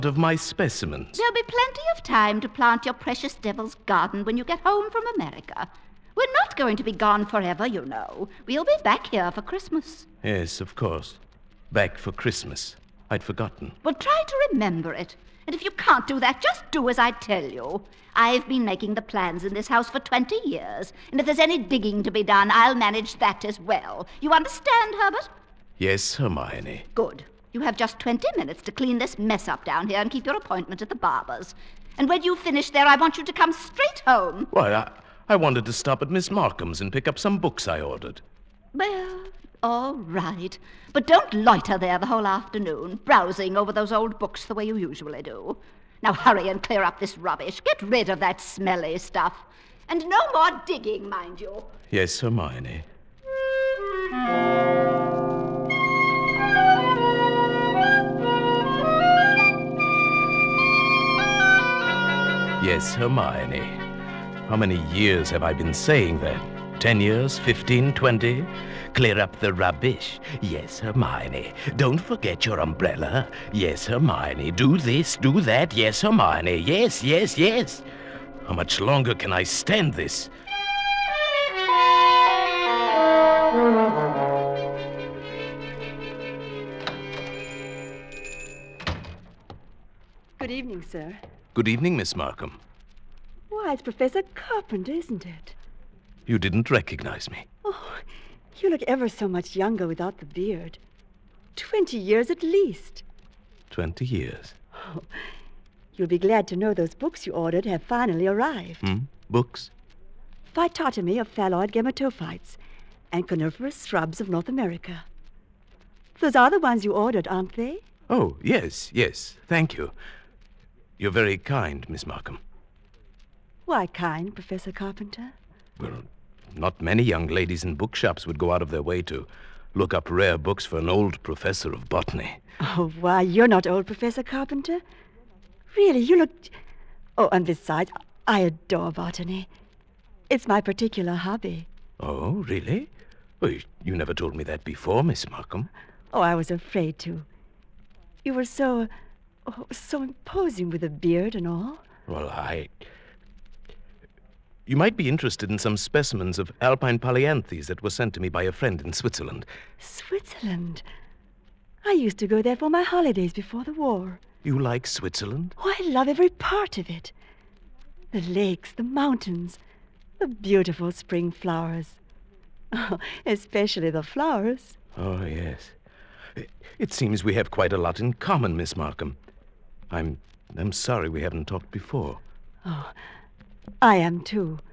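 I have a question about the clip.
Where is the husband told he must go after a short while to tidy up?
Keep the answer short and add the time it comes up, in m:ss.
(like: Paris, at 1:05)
the barber's, at 0:30.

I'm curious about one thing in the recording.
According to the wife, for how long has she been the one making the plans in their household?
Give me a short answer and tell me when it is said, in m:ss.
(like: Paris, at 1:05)
20 years, at 0:19.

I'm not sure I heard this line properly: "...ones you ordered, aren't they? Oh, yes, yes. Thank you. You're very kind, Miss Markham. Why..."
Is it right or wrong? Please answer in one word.
right.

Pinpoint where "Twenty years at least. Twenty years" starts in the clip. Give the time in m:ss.
1:41.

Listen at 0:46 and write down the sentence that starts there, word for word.
Now hurry and clear up this rubbish.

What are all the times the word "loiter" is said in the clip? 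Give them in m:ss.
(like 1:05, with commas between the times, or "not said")
0:41.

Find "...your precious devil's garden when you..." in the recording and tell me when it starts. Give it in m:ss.
0:02.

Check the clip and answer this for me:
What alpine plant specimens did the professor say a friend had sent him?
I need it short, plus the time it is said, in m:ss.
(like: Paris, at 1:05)
alpine polyanthes, at 2:36.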